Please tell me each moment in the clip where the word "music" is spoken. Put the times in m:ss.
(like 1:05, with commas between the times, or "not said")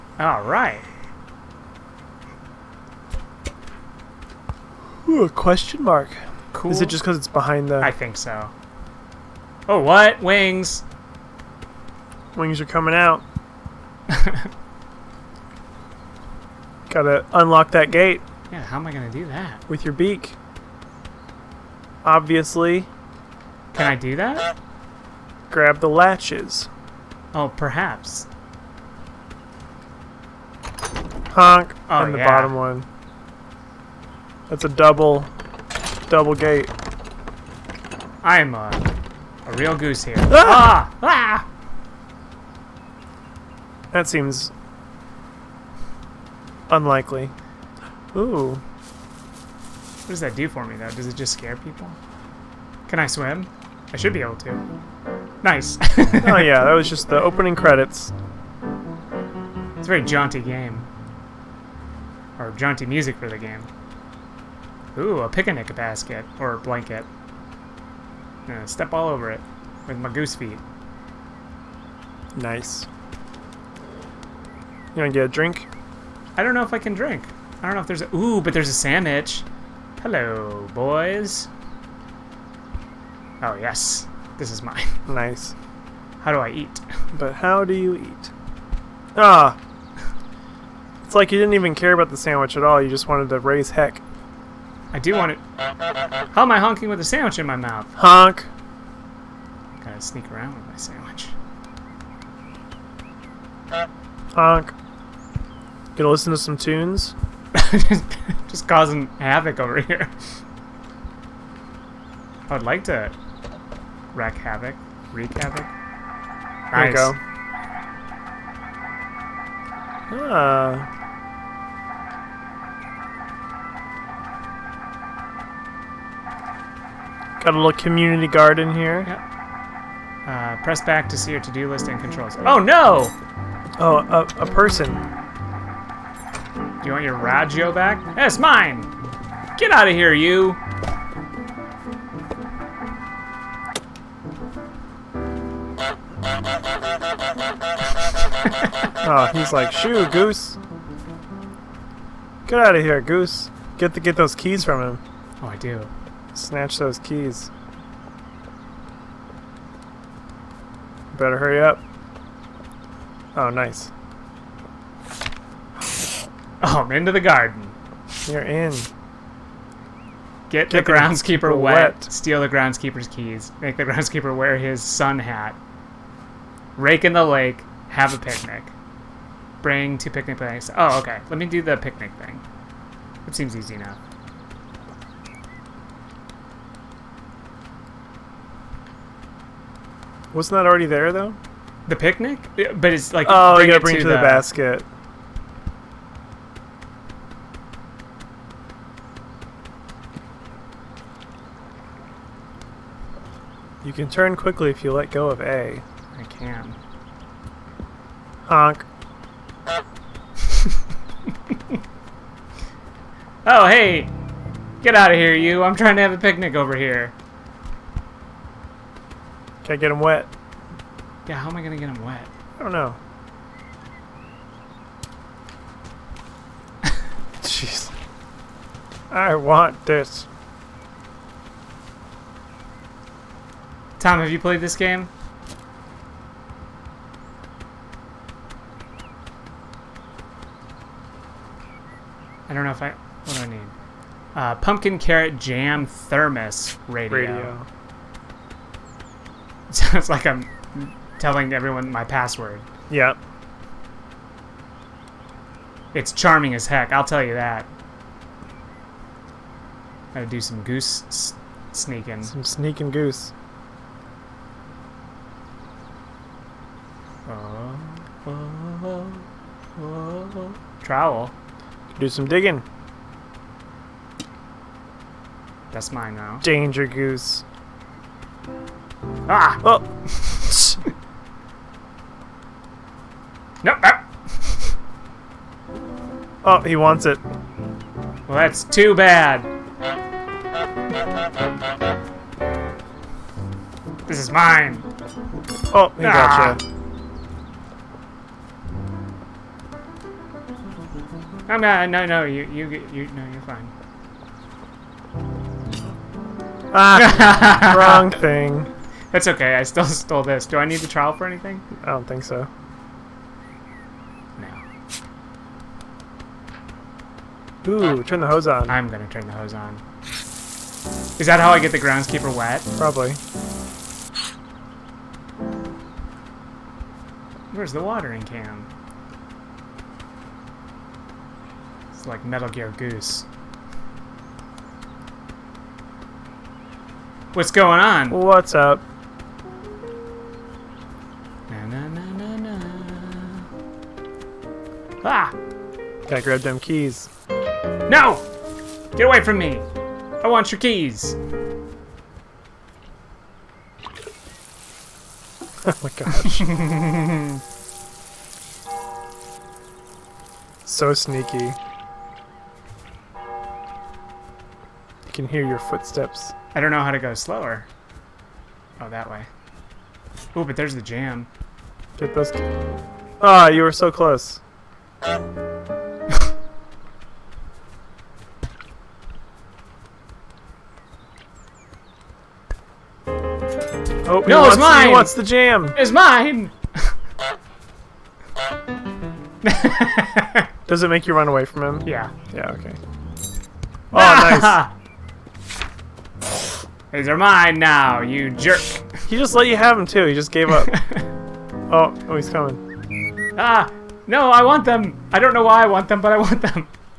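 1:02.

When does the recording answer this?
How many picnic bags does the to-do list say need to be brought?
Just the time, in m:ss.
2:59.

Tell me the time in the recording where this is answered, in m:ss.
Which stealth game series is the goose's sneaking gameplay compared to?
5:32.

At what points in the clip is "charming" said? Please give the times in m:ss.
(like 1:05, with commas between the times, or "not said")
4:16.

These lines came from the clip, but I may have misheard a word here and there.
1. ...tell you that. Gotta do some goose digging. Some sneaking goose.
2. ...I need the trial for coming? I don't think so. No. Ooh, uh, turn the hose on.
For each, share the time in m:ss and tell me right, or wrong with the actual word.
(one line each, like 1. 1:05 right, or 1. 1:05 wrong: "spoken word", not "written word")
1. 4:17 wrong: "sneaking", not "digging"
2. 5:10 wrong: "anything", not "coming".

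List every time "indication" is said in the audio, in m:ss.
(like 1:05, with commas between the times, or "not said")
not said.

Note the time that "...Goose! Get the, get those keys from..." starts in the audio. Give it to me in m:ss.
2:33.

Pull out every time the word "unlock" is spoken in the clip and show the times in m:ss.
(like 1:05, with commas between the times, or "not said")
0:17.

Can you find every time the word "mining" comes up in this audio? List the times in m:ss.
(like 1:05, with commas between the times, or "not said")
not said.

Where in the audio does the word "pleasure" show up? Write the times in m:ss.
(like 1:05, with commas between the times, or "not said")
not said.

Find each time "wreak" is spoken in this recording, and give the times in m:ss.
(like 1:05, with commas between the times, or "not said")
1:55.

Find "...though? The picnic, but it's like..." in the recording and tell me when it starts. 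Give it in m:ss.
3:11.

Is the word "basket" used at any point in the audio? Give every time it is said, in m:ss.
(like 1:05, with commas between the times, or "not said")
1:05, 3:14.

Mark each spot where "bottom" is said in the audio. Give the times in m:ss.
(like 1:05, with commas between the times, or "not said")
0:32.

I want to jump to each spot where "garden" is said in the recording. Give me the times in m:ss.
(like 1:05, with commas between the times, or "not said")
2:08, 2:47.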